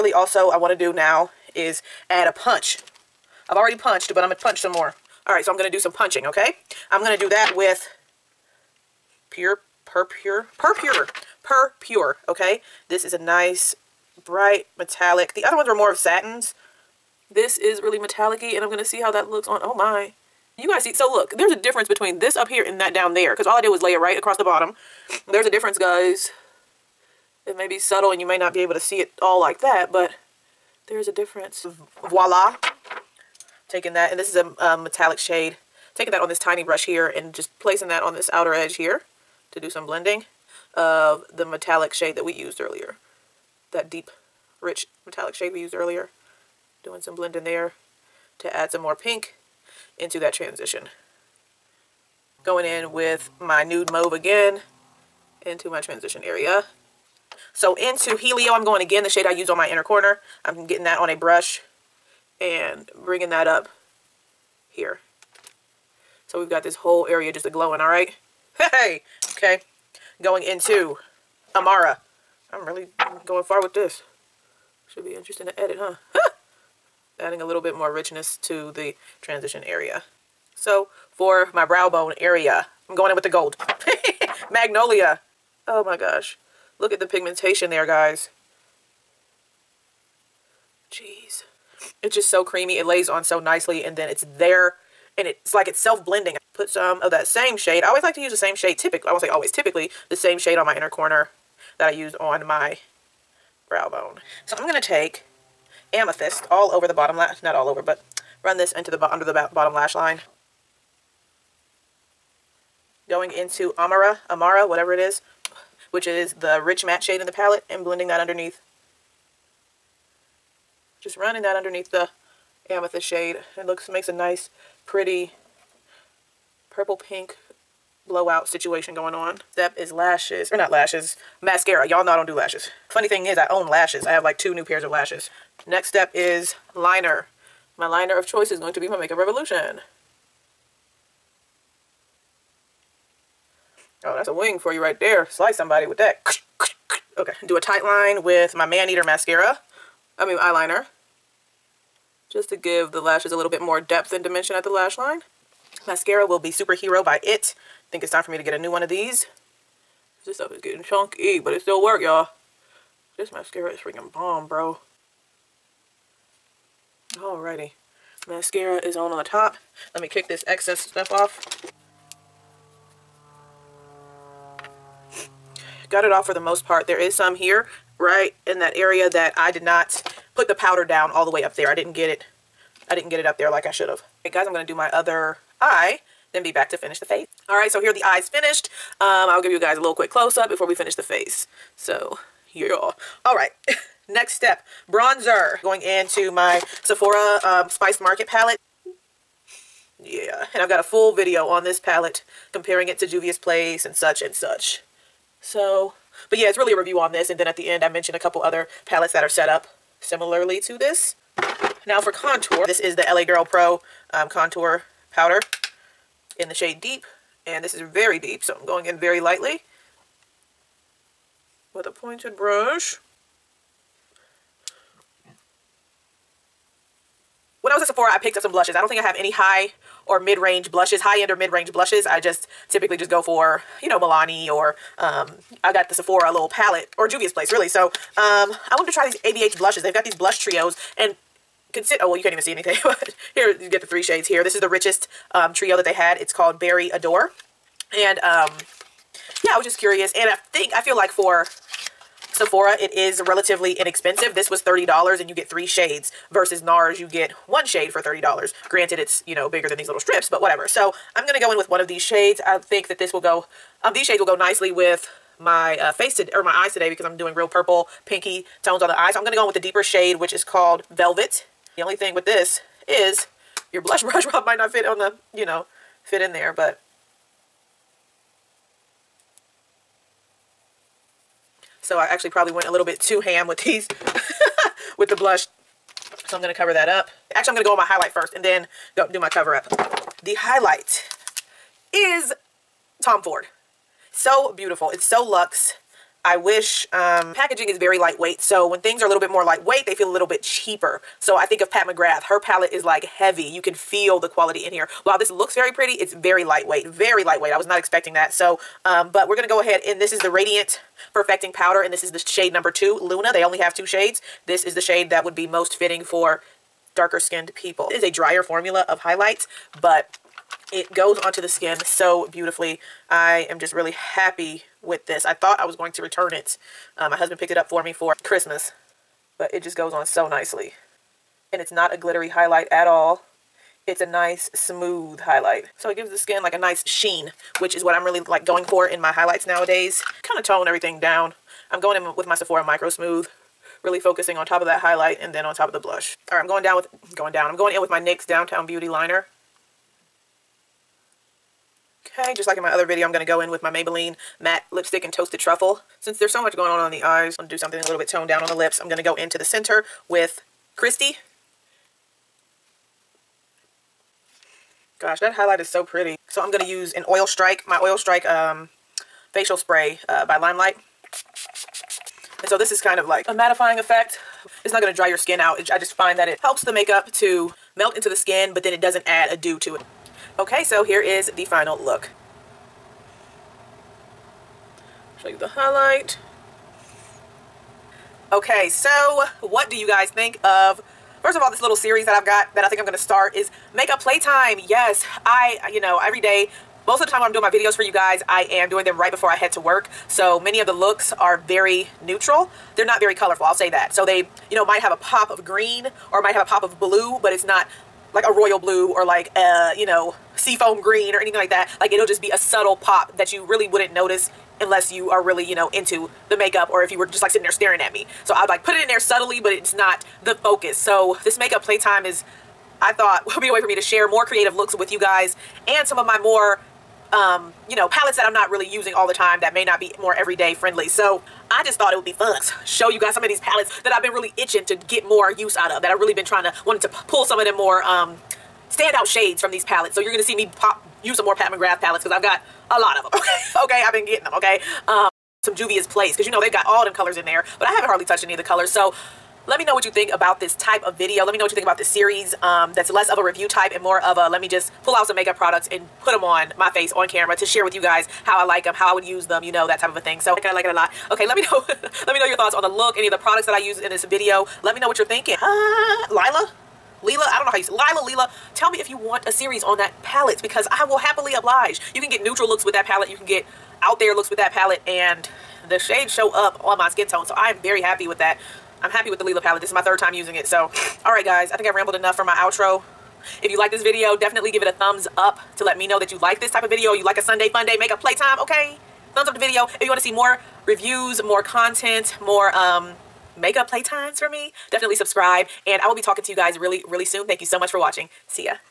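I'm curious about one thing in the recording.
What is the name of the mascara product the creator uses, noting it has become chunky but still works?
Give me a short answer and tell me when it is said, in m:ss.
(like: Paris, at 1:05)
Superhero, at 2:36.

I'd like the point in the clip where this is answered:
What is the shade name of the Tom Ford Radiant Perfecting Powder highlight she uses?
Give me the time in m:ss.
5:13.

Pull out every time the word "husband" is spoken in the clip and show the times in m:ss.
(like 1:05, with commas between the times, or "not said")
5:27.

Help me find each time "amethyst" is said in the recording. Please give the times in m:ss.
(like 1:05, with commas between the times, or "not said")
1:45, 2:02.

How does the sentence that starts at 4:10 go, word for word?
And I think, I feel like for Sephora, it is relatively inexpensive.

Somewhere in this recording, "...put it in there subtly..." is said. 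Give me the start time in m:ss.
6:58.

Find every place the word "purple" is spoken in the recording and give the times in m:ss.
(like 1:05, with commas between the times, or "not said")
2:06, 4:27.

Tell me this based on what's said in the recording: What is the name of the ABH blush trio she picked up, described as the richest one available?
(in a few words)
Berry Adore.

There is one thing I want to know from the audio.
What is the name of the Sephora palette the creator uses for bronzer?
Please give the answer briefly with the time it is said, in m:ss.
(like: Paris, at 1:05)
Spiced Market, at 3:17.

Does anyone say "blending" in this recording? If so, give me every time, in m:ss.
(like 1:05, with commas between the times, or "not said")
0:39, 0:47, 1:35, 1:57.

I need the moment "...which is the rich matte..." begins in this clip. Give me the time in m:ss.
1:55.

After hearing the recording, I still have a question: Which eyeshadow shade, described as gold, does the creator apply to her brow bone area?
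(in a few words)
Magnolia.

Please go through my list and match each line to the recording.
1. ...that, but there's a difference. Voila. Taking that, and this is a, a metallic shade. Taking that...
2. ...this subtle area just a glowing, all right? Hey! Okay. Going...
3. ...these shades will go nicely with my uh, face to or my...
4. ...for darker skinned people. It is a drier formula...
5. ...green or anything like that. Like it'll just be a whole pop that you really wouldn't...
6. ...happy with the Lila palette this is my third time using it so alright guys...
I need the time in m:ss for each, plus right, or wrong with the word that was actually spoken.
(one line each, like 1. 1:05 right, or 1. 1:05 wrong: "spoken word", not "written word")
1. 0:29 right
2. 1:06 wrong: "whole", not "subtle"
3. 4:23 right
4. 5:16 right
5. 6:50 wrong: "subtle", not "whole"
6. 7:58 right.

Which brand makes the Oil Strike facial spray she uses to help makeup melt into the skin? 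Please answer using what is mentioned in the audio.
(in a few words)
Limelife.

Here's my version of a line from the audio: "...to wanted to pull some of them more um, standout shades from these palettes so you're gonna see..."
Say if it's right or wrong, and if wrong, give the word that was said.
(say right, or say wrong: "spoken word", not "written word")
right.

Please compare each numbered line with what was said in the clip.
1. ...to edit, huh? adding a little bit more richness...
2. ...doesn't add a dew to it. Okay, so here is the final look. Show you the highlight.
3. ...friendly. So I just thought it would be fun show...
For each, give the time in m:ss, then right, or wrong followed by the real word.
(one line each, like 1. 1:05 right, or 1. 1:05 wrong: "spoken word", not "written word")
1. 1:15 right
2. 6:18 right
3. 7:10 right.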